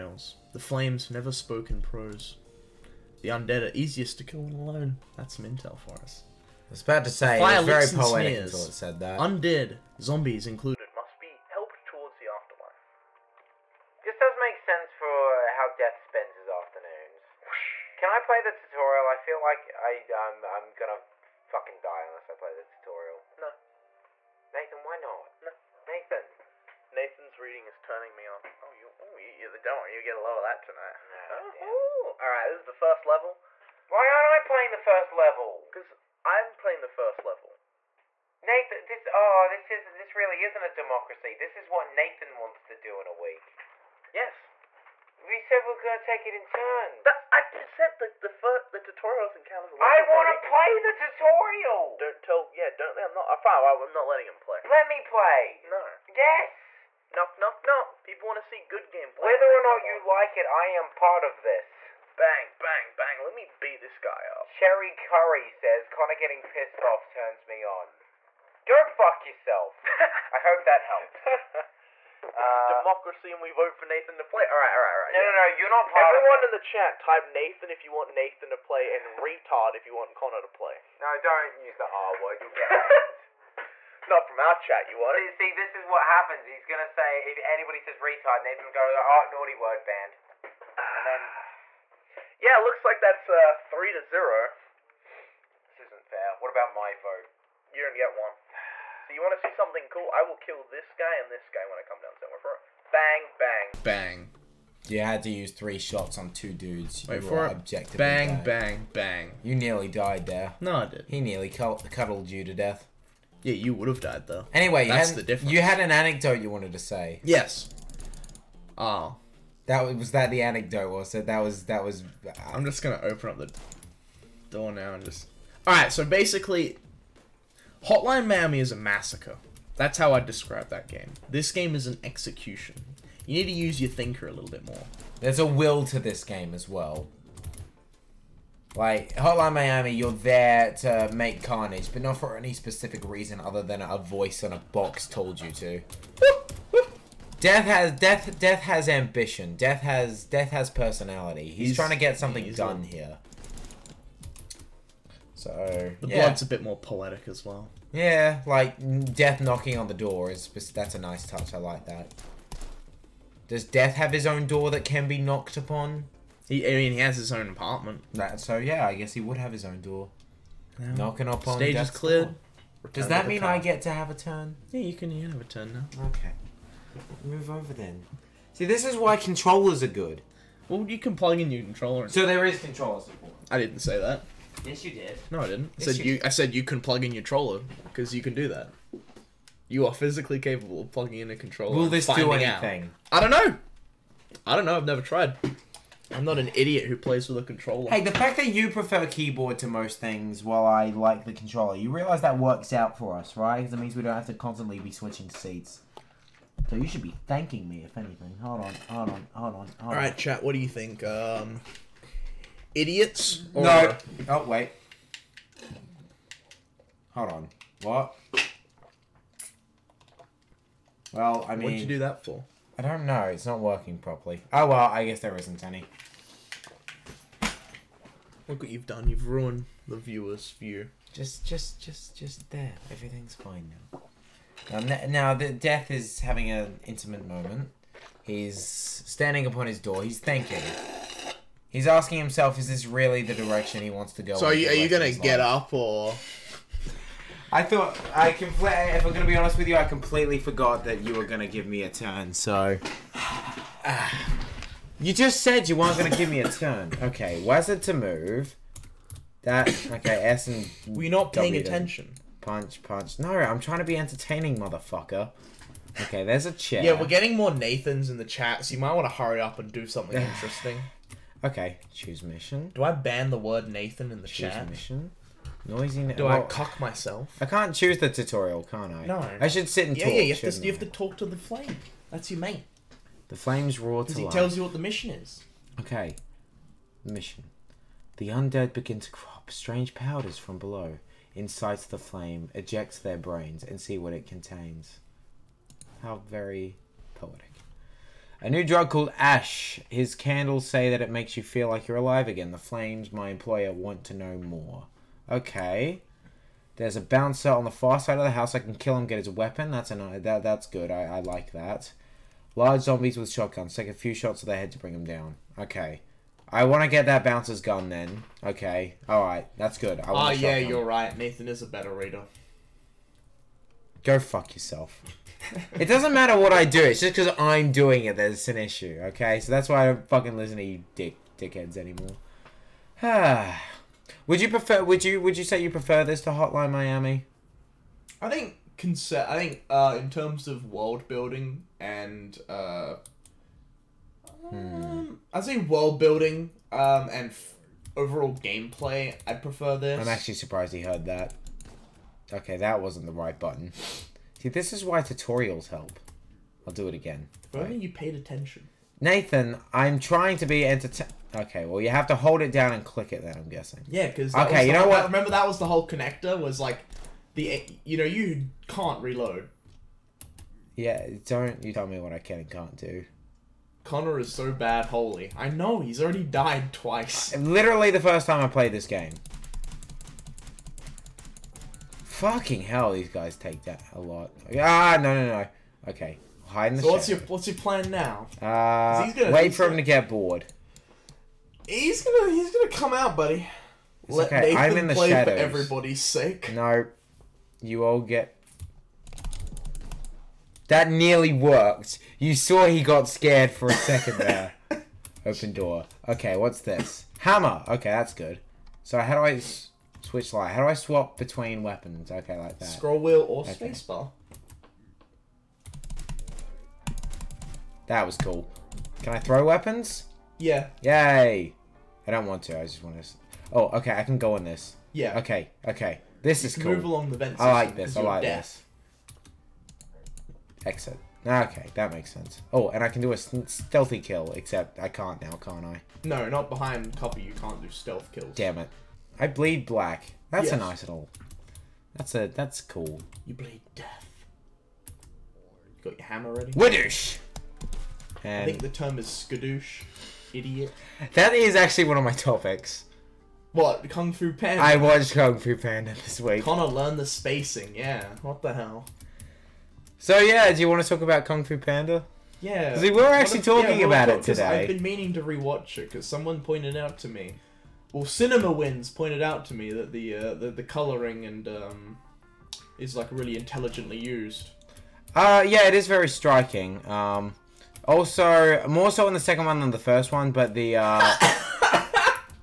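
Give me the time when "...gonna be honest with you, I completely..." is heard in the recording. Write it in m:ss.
4:09.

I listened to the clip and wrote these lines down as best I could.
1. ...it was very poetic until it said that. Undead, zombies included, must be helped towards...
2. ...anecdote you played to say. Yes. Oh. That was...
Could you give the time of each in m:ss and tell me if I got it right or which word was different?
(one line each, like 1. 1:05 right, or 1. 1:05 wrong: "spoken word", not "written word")
1. 0:07 right
2. 1:55 wrong: "wanted", not "played".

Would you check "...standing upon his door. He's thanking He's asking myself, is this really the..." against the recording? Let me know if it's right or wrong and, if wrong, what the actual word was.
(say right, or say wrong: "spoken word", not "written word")
wrong: "himself", not "myself".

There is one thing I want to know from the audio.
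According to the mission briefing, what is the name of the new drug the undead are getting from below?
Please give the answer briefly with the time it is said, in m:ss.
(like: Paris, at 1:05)
ash, at 4:59.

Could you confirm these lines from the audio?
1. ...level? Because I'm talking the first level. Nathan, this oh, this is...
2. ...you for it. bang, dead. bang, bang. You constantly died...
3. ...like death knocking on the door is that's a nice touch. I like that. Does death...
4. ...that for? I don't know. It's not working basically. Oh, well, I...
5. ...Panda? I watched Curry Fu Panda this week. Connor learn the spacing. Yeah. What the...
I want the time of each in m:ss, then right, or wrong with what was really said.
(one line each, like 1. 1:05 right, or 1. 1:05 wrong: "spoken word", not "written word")
1. 0:35 wrong: "playing", not "talking"
2. 1:47 wrong: "nearly", not "constantly"
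3. 2:38 right
4. 3:41 wrong: "properly", not "basically"
5. 7:34 wrong: "Kung", not "Curry".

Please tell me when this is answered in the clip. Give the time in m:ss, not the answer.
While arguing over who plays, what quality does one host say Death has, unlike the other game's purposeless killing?
2:28.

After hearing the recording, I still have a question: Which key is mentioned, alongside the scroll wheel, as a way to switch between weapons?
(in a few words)
spacebar.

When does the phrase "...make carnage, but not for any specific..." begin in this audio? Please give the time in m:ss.
2:21.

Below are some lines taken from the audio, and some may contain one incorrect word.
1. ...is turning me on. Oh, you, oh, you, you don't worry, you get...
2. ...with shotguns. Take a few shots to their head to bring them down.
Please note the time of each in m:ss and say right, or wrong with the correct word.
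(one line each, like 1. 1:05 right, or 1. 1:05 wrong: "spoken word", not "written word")
1. 0:27 right
2. 5:13 right.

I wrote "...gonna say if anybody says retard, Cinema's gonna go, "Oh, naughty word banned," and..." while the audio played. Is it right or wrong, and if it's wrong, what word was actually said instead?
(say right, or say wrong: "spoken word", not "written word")
wrong: "Nathan", not "Cinema".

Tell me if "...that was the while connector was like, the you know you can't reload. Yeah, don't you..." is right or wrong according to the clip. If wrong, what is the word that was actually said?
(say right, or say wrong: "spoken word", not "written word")
wrong: "whole", not "while".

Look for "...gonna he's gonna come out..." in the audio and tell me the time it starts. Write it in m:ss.
6:32.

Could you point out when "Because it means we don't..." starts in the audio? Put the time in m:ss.
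3:23.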